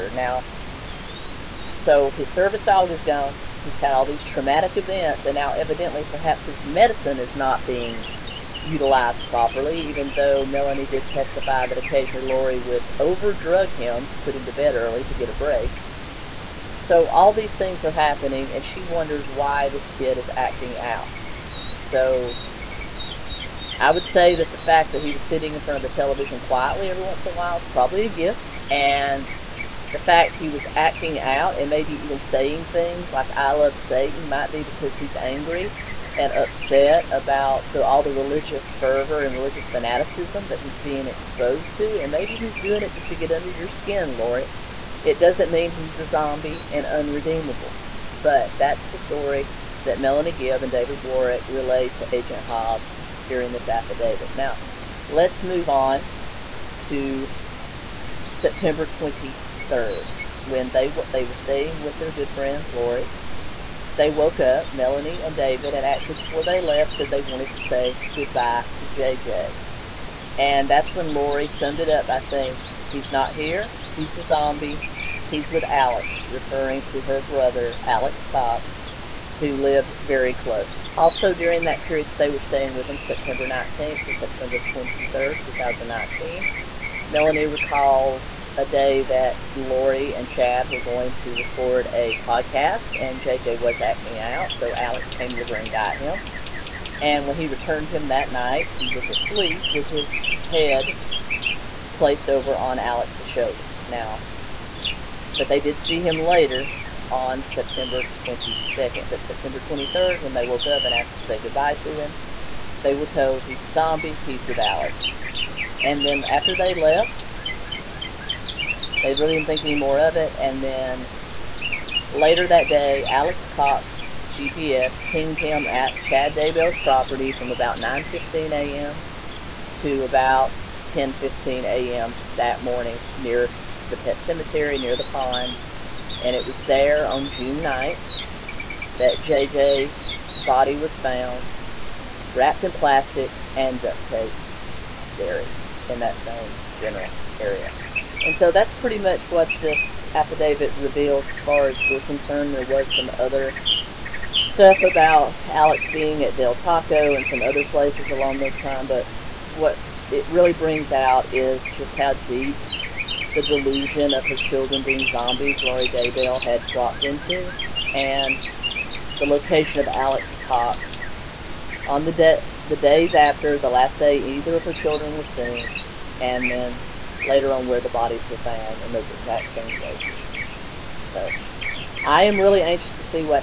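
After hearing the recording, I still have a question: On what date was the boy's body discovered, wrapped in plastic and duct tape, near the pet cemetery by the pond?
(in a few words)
June 9th.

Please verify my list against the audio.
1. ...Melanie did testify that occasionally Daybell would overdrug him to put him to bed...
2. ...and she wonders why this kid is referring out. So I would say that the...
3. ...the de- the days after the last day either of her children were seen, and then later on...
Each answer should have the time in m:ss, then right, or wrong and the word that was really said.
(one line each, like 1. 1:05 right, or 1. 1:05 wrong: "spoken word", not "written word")
1. 0:10 wrong: "Lori", not "Daybell"
2. 0:18 wrong: "acting", not "referring"
3. 2:52 right.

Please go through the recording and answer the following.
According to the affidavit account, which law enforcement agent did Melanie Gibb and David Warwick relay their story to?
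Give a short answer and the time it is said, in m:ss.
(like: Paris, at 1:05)
Agent Hobb, at 0:52.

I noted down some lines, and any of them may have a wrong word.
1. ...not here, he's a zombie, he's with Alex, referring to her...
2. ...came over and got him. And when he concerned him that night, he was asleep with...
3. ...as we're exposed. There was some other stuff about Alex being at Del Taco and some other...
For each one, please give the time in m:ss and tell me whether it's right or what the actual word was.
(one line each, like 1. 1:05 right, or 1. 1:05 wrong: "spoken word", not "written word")
1. 1:13 right
2. 1:35 wrong: "returned", not "concerned"
3. 2:31 wrong: "concerned", not "exposed".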